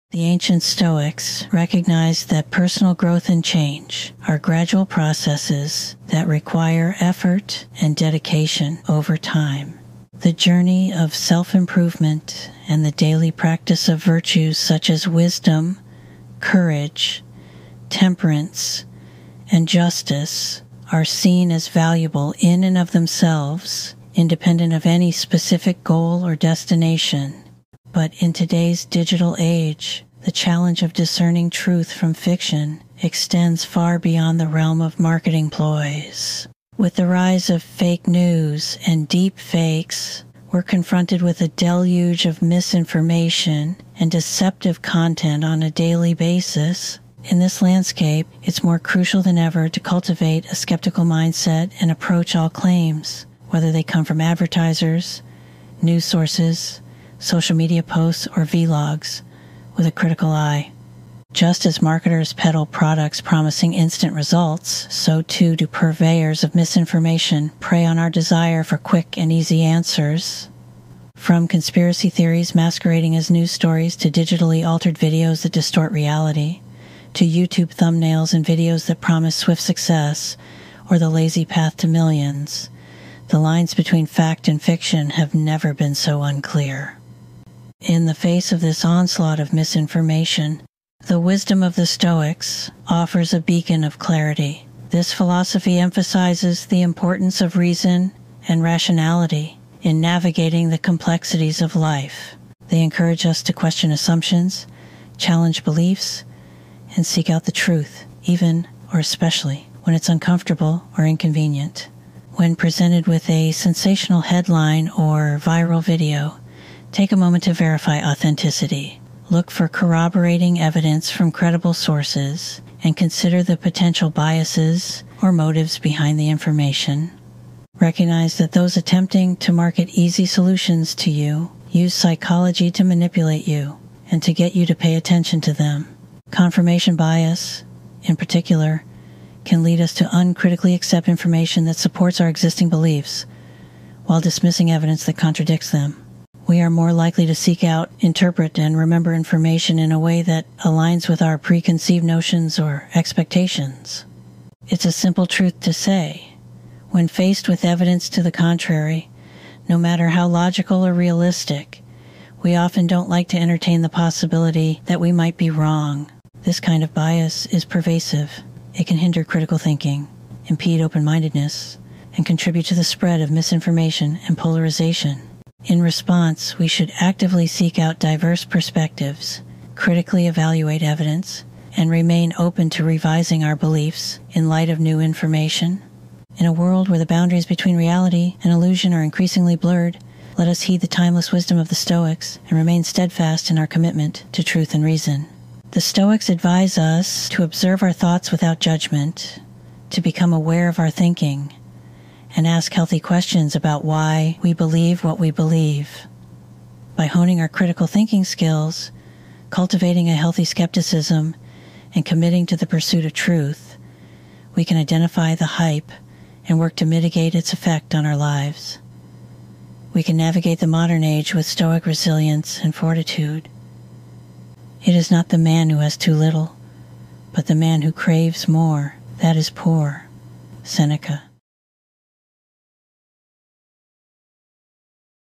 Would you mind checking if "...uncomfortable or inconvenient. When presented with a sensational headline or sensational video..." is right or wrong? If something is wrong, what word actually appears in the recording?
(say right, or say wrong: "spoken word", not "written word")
wrong: "viral", not "sensational".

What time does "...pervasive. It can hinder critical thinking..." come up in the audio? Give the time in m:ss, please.
2:47.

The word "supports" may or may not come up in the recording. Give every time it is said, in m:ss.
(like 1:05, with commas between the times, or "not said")
2:21.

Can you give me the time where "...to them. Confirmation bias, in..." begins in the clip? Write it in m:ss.
2:15.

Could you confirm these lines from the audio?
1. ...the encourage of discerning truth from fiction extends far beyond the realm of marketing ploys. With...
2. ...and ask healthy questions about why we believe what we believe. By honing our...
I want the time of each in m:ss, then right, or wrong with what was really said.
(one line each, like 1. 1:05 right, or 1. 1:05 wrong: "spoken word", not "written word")
1. 0:30 wrong: "challenge", not "encourage"
2. 3:22 right.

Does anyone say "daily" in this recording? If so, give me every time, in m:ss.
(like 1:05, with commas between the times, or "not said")
0:12, 0:45.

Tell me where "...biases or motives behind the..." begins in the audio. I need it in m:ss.
2:04.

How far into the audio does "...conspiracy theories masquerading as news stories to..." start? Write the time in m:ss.
1:11.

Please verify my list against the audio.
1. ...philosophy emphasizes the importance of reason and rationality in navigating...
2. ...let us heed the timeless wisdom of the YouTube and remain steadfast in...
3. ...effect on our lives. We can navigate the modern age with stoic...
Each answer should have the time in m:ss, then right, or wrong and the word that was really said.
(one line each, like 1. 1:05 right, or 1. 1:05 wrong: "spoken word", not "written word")
1. 1:35 right
2. 3:10 wrong: "Stoics", not "YouTube"
3. 3:37 right.